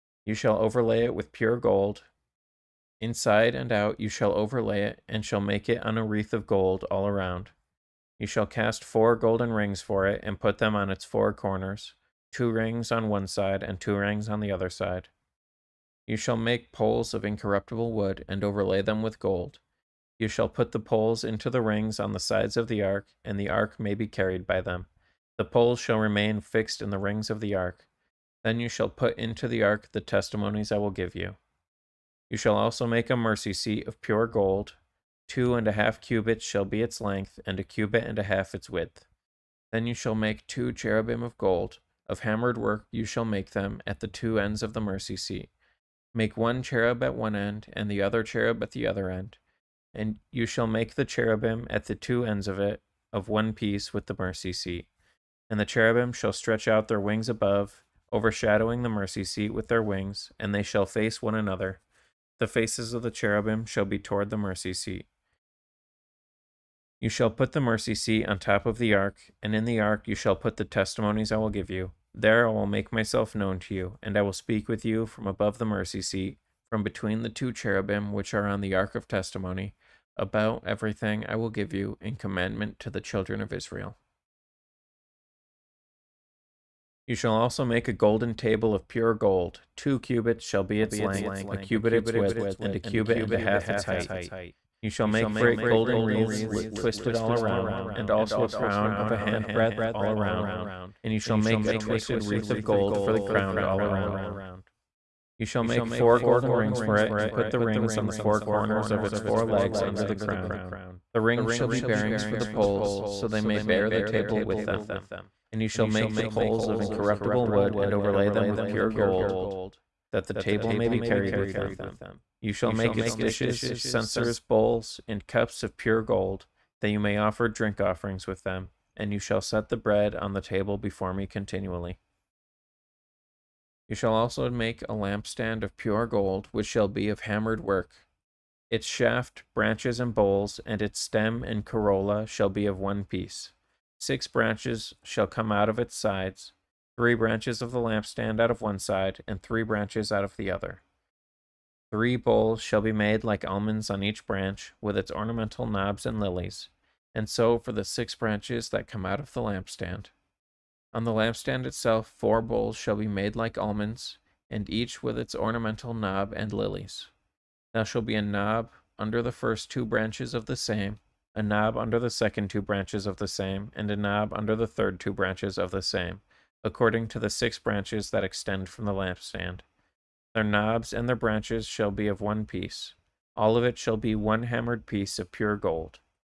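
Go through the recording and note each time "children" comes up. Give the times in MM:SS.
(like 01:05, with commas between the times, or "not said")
01:23.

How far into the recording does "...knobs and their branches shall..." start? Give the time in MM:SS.
03:00.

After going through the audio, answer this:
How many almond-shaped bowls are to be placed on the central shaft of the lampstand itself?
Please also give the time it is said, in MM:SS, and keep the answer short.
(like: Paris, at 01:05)
4, at 02:42.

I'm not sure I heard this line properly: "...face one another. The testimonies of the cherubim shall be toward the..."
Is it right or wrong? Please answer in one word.
wrong.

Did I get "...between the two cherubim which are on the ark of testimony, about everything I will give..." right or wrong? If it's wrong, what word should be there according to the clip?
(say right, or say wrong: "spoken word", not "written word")
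right.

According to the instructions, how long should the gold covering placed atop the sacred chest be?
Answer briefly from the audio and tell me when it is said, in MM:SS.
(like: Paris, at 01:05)
2.5 cubits, at 00:35.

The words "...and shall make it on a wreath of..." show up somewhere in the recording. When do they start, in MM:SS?
00:05.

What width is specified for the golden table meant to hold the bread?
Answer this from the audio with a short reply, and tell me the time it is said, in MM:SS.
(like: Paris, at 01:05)
1 cubit, at 01:31.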